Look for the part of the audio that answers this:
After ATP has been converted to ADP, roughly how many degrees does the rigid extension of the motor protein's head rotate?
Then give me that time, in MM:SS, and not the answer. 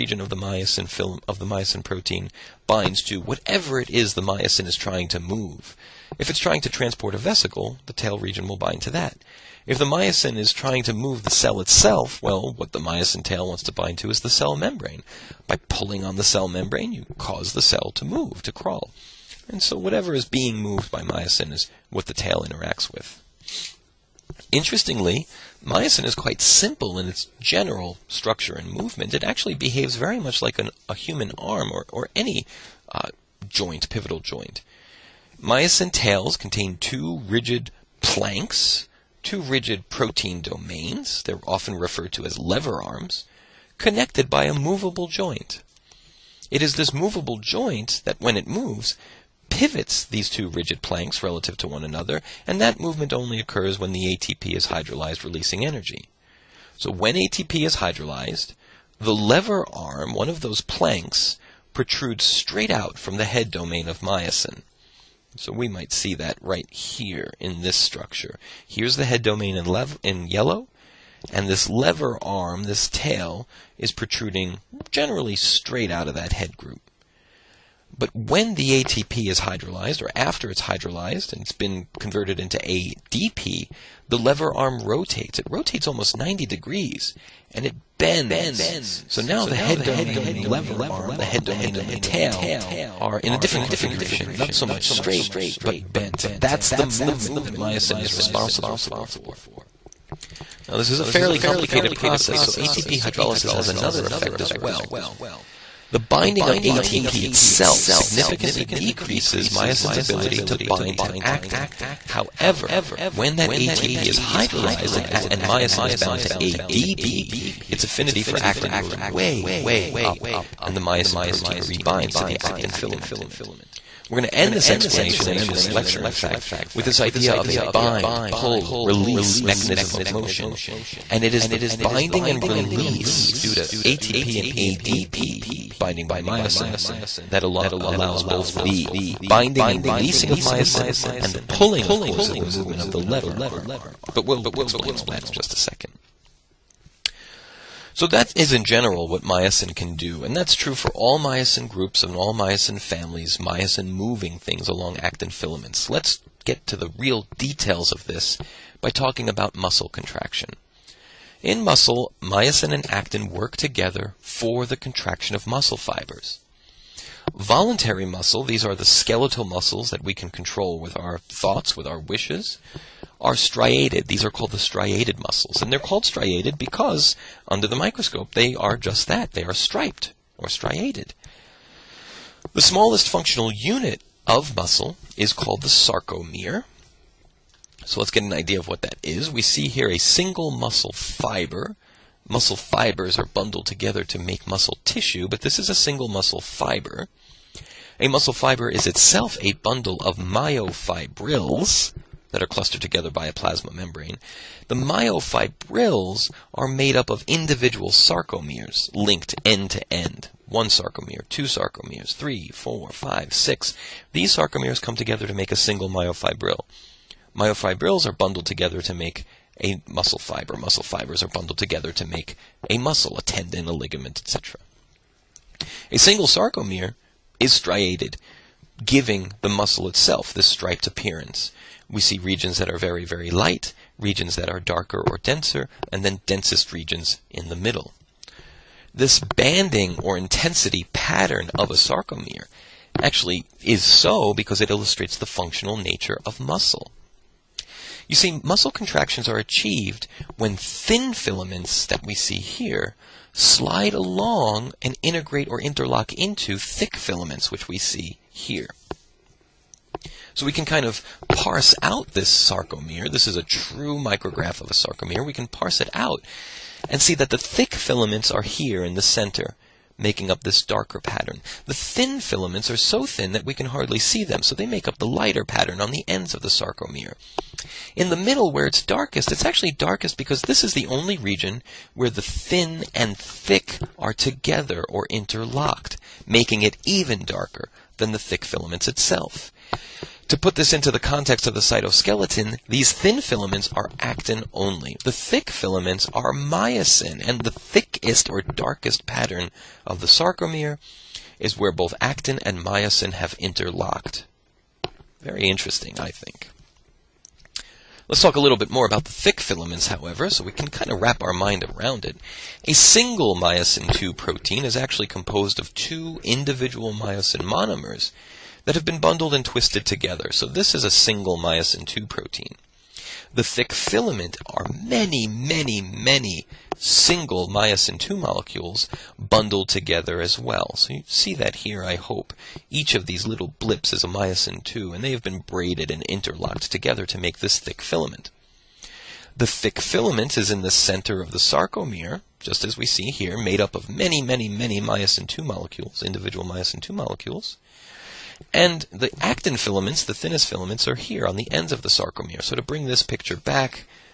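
01:26.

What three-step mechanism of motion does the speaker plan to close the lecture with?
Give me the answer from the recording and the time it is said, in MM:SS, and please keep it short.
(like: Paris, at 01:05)
bind, pull, release, at 02:07.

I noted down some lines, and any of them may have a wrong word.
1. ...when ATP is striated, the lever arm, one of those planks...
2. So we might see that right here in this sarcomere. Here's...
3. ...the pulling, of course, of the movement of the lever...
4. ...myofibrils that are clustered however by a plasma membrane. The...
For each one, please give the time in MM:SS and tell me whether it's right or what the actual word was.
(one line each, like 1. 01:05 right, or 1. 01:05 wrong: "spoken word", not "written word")
1. 00:56 wrong: "hydrolyzed", not "striated"
2. 01:05 wrong: "structure", not "sarcomere"
3. 02:21 right
4. 03:20 wrong: "together", not "however".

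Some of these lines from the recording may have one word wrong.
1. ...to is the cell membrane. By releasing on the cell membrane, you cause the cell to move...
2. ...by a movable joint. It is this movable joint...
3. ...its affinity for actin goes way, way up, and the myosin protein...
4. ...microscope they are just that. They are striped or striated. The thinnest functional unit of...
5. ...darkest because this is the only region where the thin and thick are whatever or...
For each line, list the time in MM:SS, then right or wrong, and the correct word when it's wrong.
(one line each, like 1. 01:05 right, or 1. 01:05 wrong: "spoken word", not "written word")
1. 00:13 wrong: "pulling", not "releasing"
2. 00:44 right
3. 01:57 right
4. 02:57 wrong: "smallest", not "thinnest"
5. 04:39 wrong: "together", not "whatever".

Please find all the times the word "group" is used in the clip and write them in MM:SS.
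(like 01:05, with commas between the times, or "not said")
01:16, 02:31.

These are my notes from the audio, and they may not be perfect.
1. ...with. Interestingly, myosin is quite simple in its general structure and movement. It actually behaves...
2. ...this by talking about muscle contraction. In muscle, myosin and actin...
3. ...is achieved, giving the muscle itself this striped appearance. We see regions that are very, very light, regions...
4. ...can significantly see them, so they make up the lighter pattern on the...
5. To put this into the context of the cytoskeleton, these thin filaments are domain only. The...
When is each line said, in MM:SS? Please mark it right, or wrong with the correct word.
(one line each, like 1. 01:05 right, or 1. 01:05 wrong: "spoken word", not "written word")
1. 00:22 right
2. 02:38 right
3. 03:47 wrong: "striated", not "achieved"
4. 04:33 wrong: "hardly", not "significantly"
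5. 04:50 wrong: "actin", not "domain".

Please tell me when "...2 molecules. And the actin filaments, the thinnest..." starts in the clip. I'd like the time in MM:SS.
05:46.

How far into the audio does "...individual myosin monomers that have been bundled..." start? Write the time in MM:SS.
05:16.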